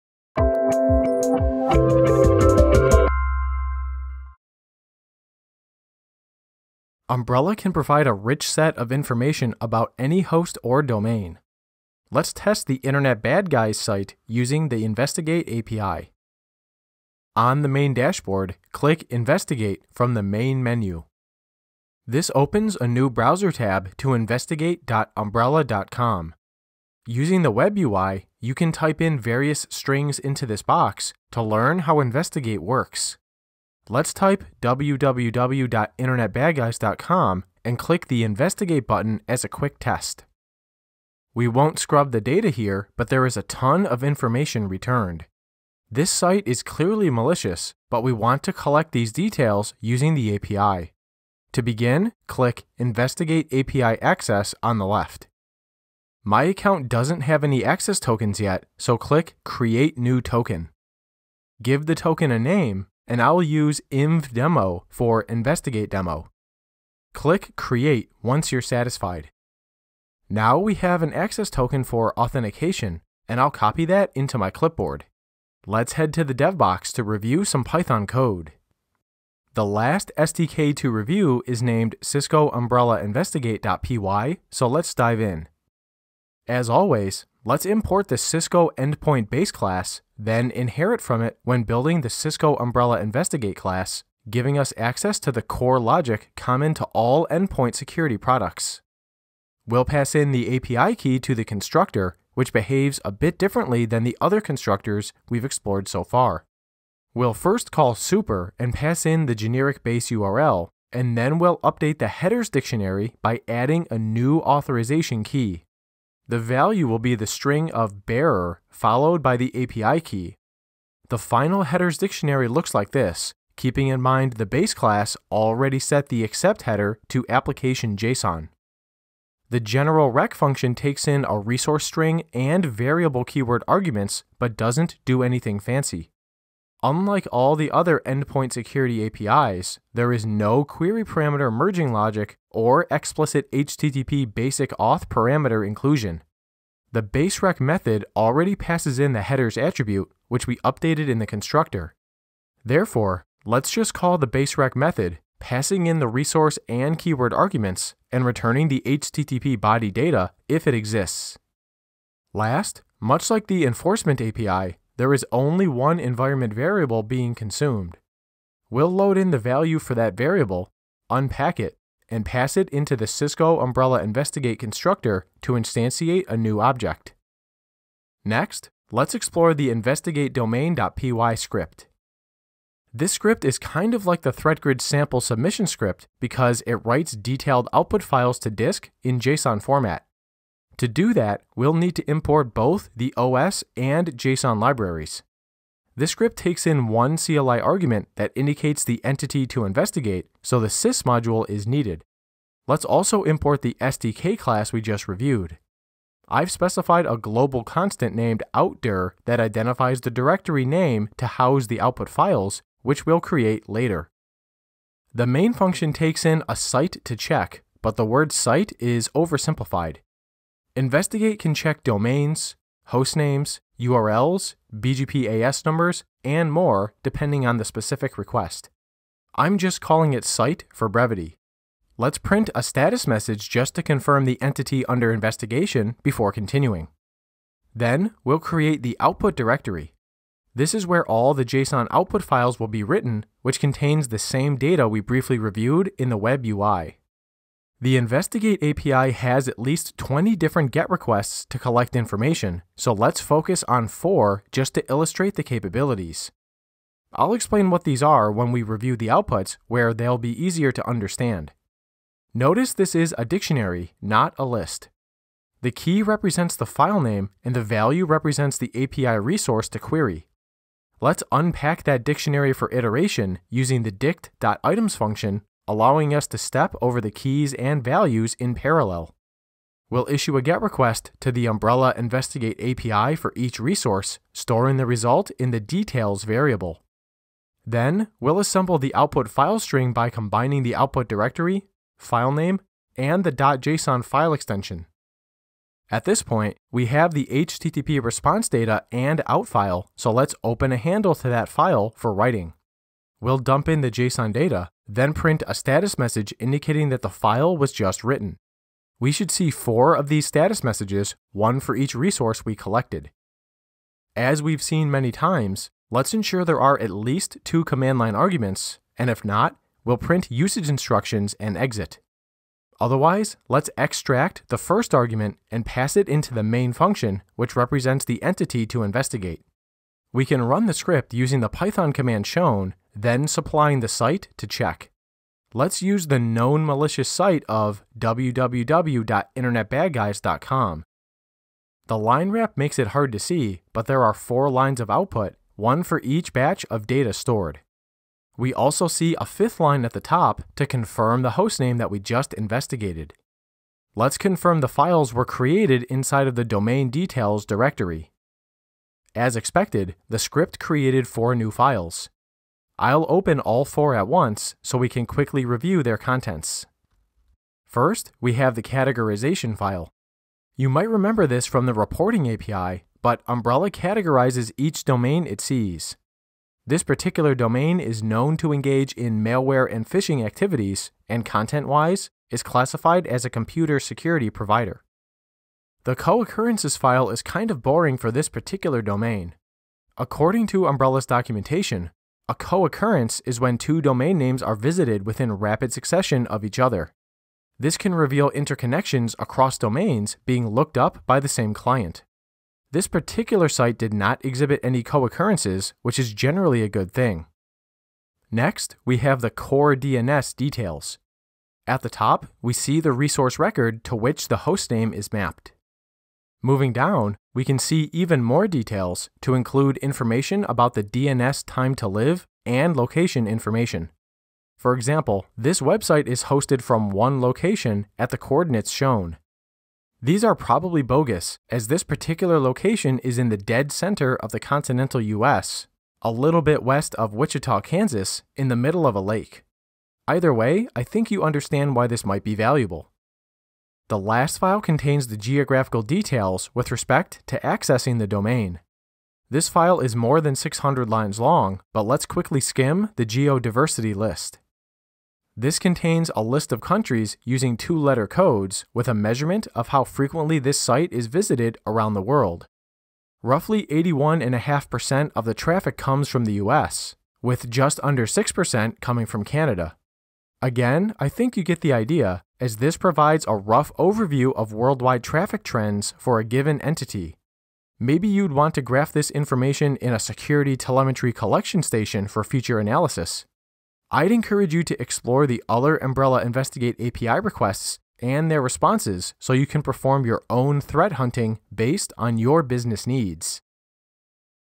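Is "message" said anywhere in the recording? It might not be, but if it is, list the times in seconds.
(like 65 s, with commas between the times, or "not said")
233 s, 305 s, 310 s.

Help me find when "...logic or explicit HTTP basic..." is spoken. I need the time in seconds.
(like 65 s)
141 s.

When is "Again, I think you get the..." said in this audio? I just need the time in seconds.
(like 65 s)
470 s.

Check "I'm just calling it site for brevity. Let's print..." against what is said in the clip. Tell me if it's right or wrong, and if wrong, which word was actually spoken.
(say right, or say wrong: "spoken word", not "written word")
right.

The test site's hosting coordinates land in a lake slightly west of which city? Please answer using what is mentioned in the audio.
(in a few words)
Wichita, Kansas.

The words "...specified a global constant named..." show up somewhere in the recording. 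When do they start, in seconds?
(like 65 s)
206 s.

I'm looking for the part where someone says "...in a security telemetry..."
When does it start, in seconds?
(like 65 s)
479 s.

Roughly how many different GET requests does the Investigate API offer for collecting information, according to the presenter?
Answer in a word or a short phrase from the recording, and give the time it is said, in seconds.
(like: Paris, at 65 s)
20, at 249 s.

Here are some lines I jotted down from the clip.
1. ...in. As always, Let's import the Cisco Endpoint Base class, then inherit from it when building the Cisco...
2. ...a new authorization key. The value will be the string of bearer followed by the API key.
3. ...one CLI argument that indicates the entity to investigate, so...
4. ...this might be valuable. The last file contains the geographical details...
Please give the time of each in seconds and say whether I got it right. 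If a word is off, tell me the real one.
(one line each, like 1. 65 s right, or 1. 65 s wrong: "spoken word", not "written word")
1. 85 s right
2. 113 s right
3. 196 s right
4. 441 s right.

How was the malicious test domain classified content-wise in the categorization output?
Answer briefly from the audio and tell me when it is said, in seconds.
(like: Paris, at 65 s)
computer security provider, at 383 s.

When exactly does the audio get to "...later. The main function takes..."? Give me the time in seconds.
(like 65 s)
213 s.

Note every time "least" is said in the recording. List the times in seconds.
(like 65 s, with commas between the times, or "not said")
249 s, 316 s.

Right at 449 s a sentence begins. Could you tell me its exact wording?
This file is more than 600 lines long, but let's quickly skim the geodiversity list.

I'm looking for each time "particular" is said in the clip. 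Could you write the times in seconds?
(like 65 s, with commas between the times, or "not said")
376 s, 388 s, 402 s, 431 s.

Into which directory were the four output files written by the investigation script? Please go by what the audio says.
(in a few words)
domain details.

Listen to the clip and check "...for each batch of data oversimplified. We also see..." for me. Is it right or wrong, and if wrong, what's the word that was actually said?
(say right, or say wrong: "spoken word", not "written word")
wrong: "stored", not "oversimplified".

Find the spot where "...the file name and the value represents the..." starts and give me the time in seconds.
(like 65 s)
266 s.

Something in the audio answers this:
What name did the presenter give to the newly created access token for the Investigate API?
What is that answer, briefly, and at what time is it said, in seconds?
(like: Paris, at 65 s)
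inv demo, at 63 s.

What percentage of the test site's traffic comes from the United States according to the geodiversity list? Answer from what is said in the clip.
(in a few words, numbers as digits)
81.5%.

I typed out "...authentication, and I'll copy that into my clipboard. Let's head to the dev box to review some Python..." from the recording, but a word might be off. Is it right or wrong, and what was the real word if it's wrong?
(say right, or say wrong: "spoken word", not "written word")
right.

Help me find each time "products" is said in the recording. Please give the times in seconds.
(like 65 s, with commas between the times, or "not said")
98 s.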